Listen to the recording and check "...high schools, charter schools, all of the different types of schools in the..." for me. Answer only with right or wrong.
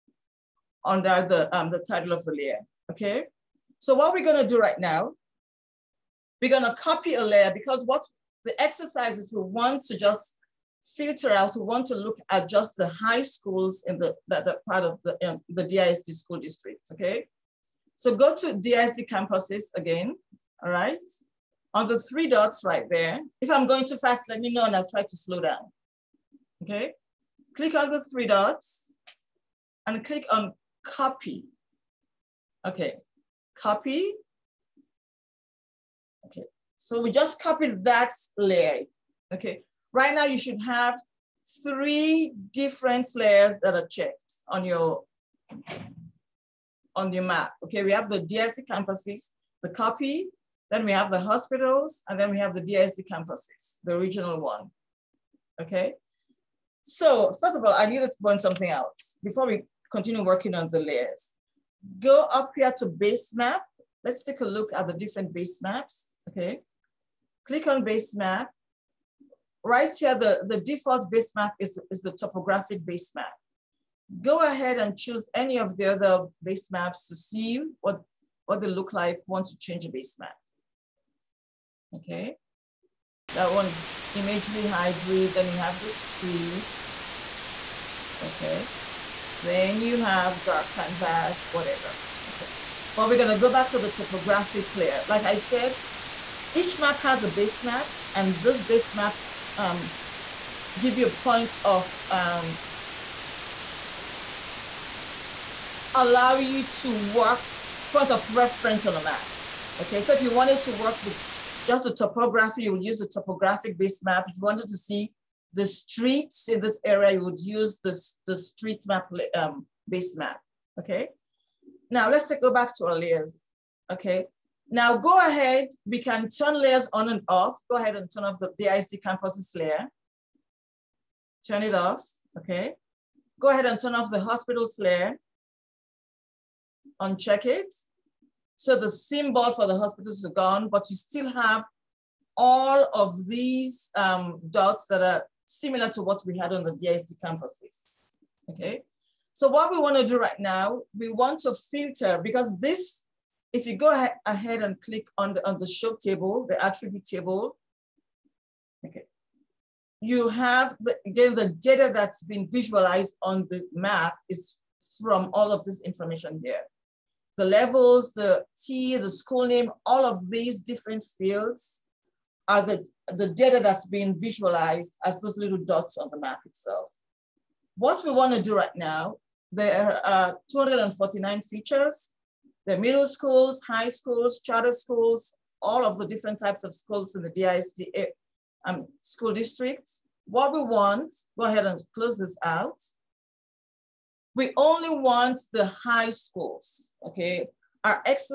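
right.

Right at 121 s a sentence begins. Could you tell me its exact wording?
Now let's go back to our layers, okay?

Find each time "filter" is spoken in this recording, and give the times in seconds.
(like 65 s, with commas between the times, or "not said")
10 s, 151 s.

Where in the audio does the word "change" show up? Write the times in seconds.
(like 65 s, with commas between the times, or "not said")
79 s.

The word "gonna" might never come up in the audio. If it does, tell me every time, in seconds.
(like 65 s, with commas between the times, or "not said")
4 s, 93 s.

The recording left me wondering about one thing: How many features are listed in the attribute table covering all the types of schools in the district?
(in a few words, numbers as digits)
249.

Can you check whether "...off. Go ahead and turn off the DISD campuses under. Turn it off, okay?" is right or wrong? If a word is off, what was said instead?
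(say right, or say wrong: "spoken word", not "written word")
wrong: "layer", not "under".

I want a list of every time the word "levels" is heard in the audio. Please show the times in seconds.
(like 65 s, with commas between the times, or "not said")
167 s.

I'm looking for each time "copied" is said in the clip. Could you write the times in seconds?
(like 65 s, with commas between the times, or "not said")
37 s.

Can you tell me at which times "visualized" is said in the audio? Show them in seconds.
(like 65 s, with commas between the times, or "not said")
162 s, 174 s.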